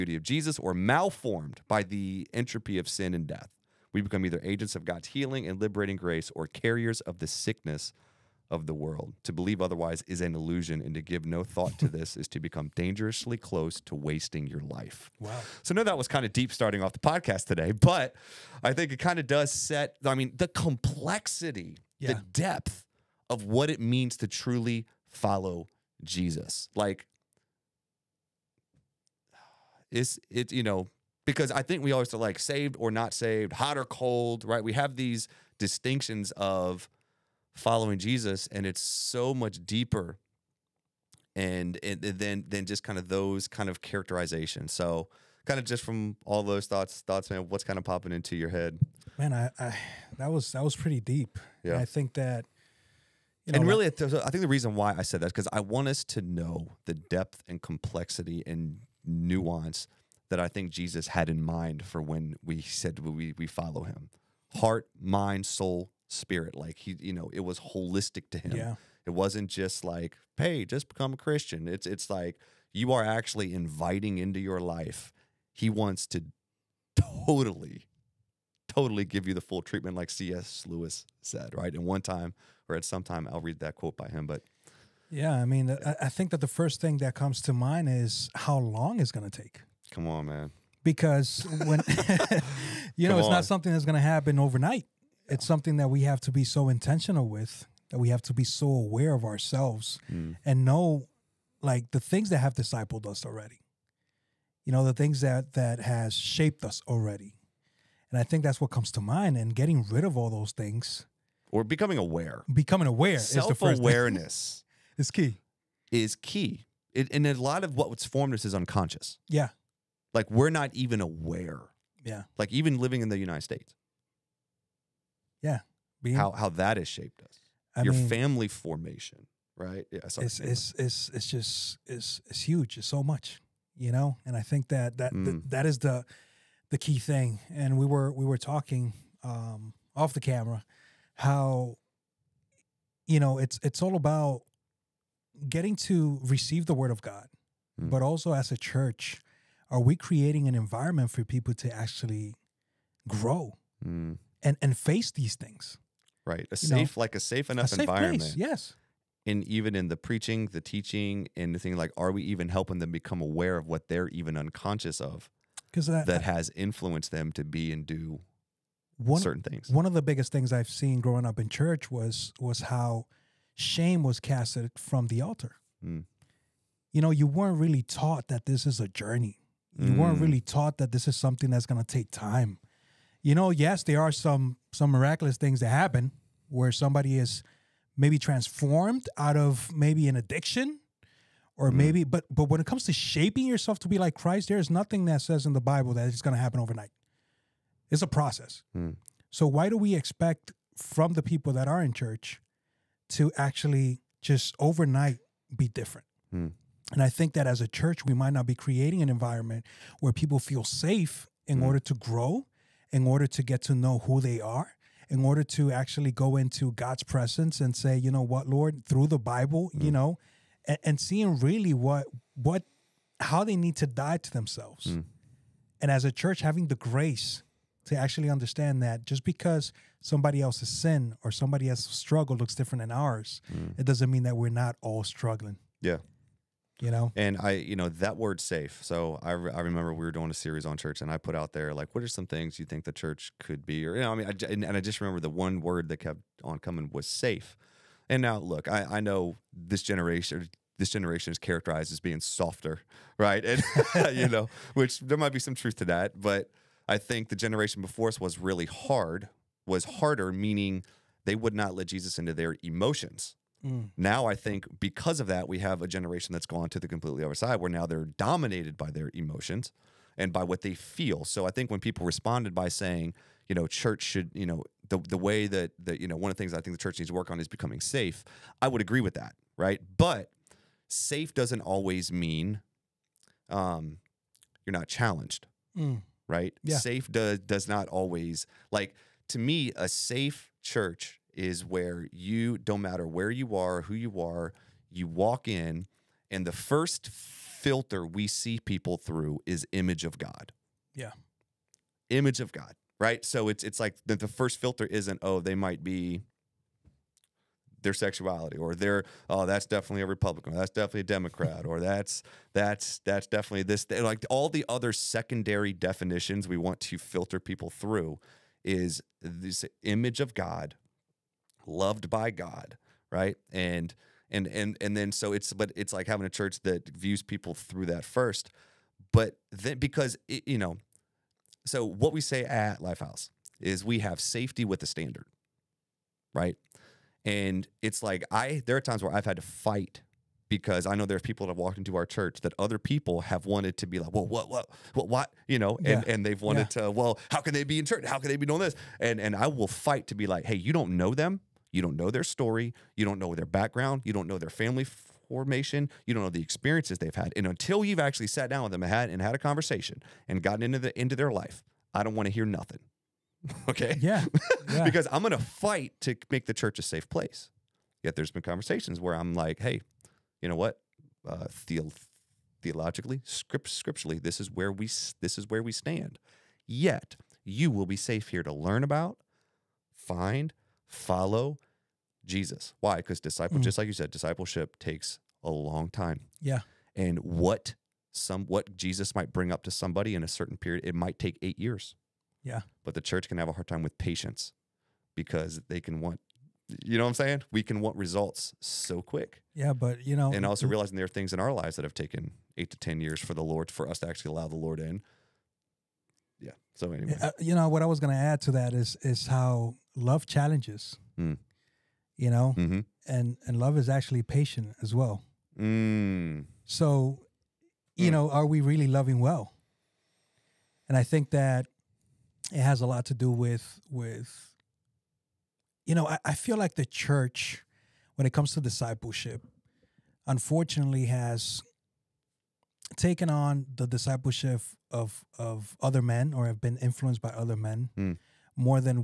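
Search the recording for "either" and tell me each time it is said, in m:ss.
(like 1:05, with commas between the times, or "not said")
0:04.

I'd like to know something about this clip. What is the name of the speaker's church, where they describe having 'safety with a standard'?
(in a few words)
Lifehouse.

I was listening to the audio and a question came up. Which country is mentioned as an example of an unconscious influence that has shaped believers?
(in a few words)
United States.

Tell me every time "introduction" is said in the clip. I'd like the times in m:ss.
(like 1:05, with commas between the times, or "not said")
not said.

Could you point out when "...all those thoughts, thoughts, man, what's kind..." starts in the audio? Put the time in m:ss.
0:46.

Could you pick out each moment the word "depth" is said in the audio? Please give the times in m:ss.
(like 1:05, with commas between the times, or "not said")
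0:22, 0:56.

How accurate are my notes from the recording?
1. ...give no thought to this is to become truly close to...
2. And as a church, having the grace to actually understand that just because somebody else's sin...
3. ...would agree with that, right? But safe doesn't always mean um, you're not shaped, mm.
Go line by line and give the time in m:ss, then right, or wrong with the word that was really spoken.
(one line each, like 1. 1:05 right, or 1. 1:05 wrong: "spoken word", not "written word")
1. 0:11 wrong: "dangerously", not "truly"
2. 3:45 right
3. 4:38 wrong: "challenged", not "shaped".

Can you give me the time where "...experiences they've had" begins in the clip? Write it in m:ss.
5:56.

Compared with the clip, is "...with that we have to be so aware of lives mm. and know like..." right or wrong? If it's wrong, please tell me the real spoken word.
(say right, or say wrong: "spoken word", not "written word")
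wrong: "ourselves", not "lives".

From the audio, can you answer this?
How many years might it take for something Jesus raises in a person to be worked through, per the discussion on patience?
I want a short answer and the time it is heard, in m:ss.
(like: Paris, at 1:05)
8, at 6:31.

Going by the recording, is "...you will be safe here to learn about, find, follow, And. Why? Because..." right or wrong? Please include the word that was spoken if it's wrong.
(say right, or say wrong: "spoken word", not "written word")
wrong: "Jesus", not "And".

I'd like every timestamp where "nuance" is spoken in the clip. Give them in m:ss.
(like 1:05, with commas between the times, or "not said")
0:59.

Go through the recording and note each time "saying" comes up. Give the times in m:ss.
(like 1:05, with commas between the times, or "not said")
4:32, 6:37.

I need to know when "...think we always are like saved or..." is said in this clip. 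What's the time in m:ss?
0:31.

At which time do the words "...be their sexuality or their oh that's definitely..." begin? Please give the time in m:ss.
5:05.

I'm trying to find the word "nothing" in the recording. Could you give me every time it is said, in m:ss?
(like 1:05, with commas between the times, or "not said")
3:14, 6:02.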